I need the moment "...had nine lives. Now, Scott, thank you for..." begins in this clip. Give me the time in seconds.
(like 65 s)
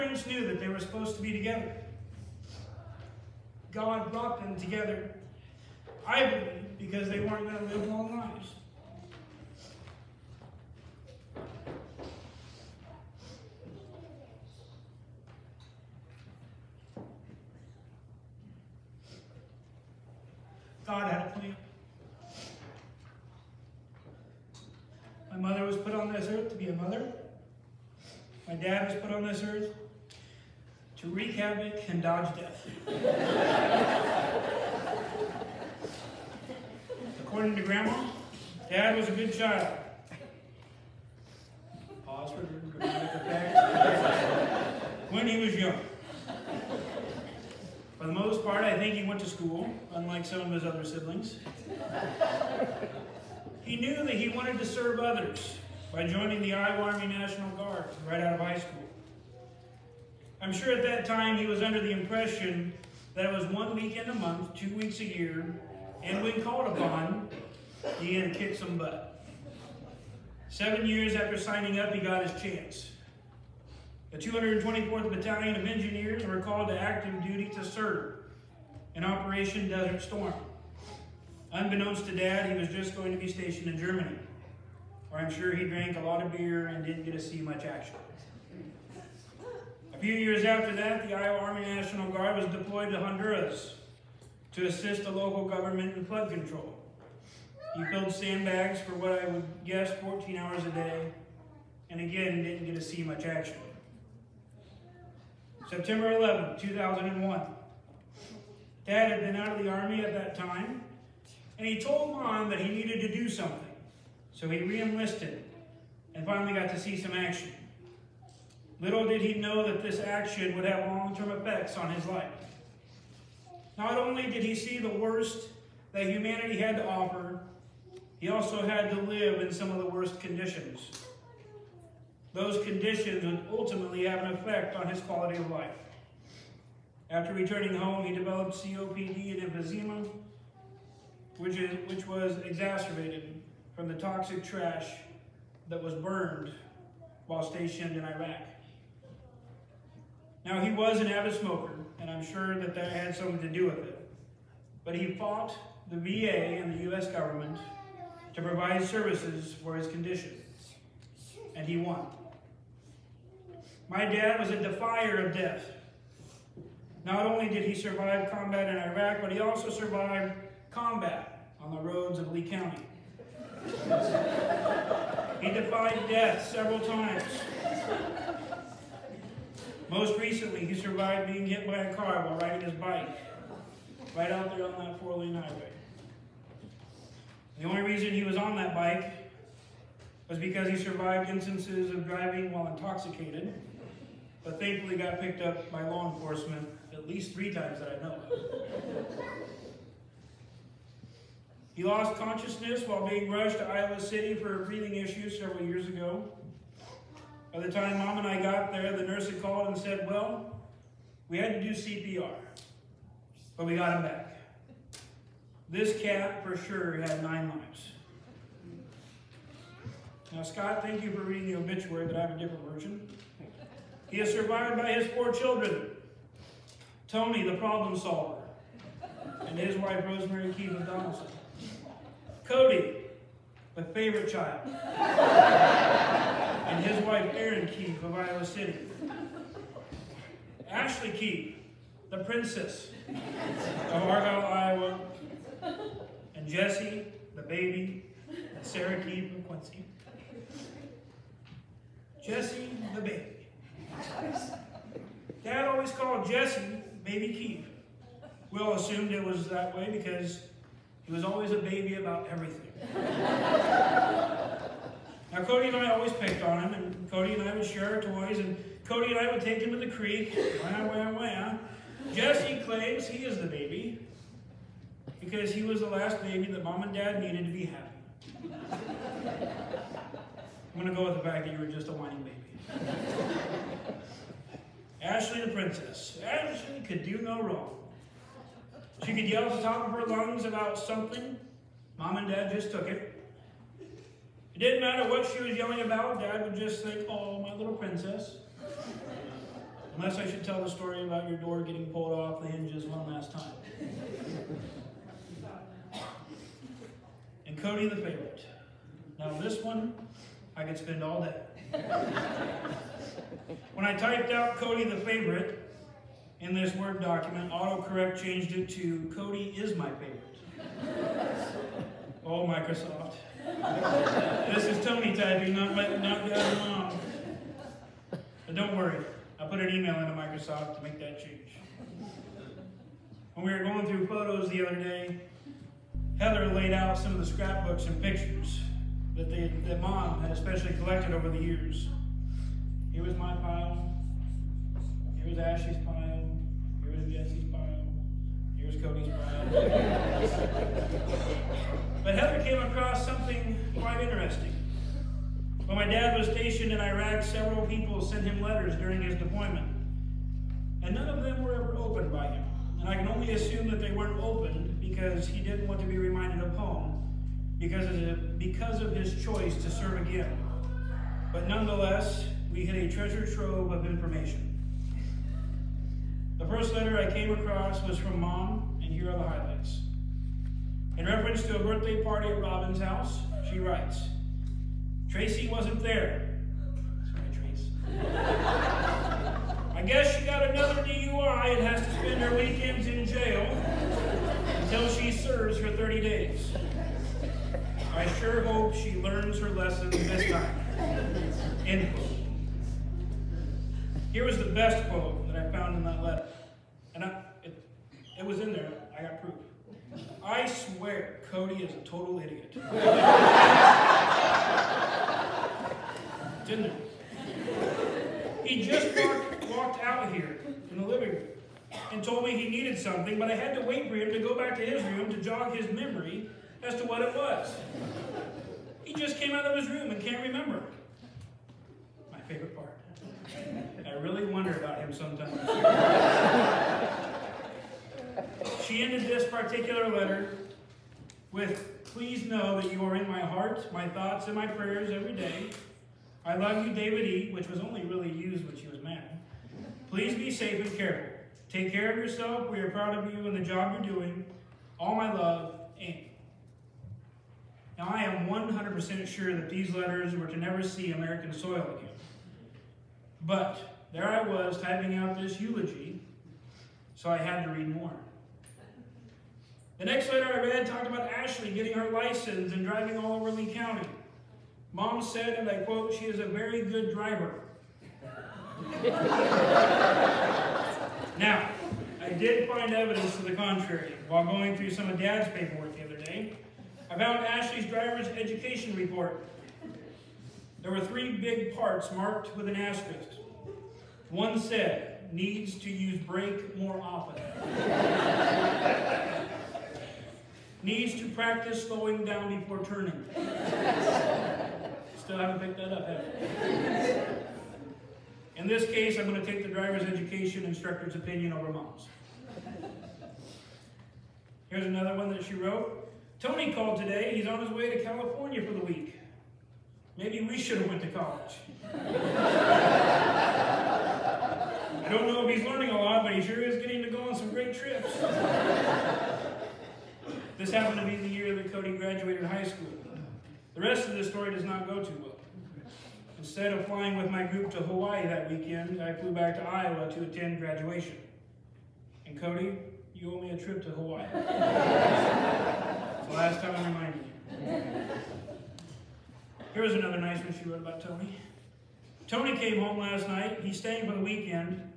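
217 s.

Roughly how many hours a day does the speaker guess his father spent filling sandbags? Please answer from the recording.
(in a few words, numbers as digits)
14.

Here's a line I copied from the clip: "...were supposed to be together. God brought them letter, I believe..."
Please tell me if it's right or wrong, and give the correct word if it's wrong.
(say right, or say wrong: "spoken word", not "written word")
wrong: "together", not "letter".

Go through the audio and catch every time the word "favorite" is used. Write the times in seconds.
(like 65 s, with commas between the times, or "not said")
233 s, 307 s, 314 s, 319 s, 432 s.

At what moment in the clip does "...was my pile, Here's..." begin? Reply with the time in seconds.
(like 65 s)
343 s.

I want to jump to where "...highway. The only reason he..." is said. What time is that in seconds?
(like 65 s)
185 s.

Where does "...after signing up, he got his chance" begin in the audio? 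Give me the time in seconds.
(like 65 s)
71 s.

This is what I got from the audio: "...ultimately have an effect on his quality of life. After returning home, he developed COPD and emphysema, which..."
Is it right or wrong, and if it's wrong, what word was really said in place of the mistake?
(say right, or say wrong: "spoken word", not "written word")
right.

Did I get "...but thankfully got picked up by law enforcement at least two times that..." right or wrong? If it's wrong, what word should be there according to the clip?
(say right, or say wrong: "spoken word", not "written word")
wrong: "three", not "two".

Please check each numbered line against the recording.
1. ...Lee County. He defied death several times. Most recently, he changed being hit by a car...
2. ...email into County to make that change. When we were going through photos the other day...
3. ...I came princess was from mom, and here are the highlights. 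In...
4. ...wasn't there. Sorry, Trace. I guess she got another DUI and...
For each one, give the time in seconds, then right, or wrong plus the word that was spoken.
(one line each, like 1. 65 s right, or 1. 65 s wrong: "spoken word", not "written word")
1. 172 s wrong: "survived", not "changed"
2. 329 s wrong: "Microsoft", not "County"
3. 376 s wrong: "across", not "princess"
4. 385 s right.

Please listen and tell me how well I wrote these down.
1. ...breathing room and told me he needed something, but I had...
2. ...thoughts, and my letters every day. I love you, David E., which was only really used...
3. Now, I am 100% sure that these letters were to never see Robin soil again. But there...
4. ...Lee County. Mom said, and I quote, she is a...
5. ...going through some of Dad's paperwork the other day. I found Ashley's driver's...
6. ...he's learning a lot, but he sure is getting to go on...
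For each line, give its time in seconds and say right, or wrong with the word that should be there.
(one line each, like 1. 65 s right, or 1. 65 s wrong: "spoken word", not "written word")
1. 420 s wrong: "living", not "breathing"
2. 443 s wrong: "prayers", not "letters"
3. 457 s wrong: "American", not "Robin"
4. 473 s right
5. 484 s right
6. 525 s right.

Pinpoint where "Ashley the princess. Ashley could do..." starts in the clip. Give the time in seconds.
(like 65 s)
285 s.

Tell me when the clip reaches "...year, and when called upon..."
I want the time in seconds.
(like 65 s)
65 s.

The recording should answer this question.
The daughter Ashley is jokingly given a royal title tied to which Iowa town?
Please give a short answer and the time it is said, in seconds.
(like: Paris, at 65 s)
Argyle, at 244 s.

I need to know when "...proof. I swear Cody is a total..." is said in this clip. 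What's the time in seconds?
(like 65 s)
409 s.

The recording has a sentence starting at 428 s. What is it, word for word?
He just came out of his room and can't remember.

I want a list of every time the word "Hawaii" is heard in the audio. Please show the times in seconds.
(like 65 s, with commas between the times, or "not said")
537 s, 543 s.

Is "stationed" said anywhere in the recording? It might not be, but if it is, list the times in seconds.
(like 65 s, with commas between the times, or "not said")
83 s, 147 s, 356 s.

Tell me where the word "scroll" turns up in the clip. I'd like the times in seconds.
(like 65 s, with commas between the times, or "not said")
not said.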